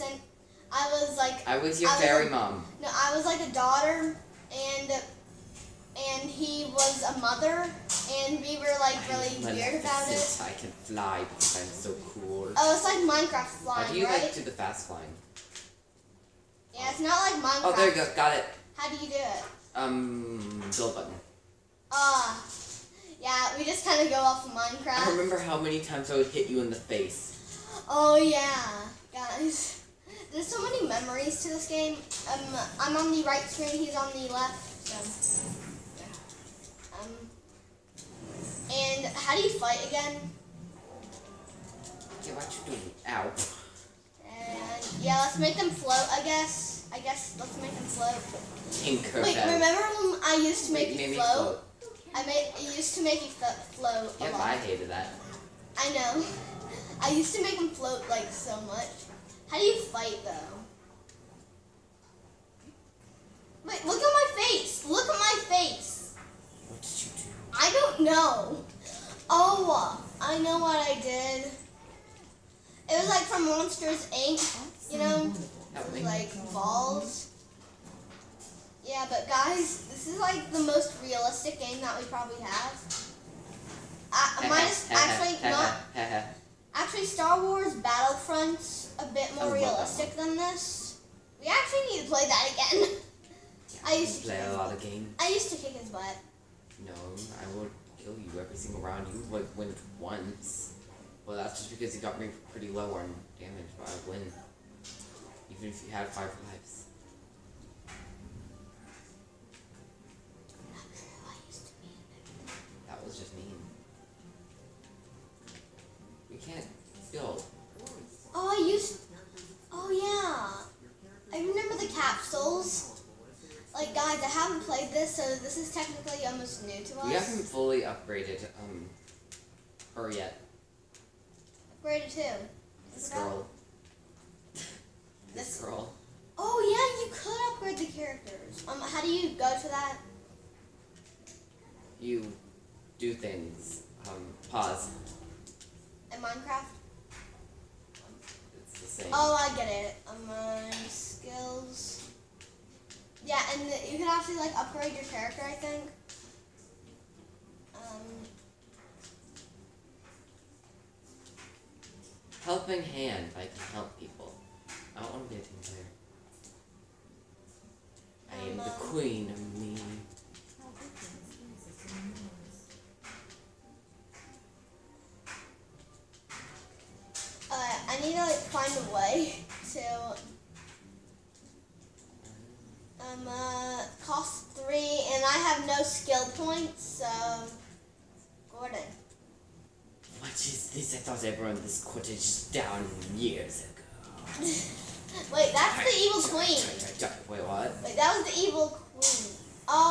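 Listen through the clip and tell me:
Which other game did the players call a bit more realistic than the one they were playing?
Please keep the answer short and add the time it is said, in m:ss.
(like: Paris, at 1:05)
Star Wars Battlefront, at 1:27.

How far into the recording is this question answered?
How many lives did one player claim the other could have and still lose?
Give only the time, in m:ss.
1:46.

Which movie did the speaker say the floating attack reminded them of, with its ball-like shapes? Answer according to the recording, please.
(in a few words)
Monsters Inc.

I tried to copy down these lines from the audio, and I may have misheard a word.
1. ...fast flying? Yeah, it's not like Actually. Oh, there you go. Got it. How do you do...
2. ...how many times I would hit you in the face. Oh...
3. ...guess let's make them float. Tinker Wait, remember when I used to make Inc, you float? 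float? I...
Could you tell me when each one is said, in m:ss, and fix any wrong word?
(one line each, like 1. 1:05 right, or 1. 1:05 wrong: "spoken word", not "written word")
1. 0:14 wrong: "Minecraft", not "Actually"
2. 0:25 right
3. 0:46 wrong: "Wait", not "Inc".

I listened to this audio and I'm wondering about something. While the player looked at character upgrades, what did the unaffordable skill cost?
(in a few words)
3.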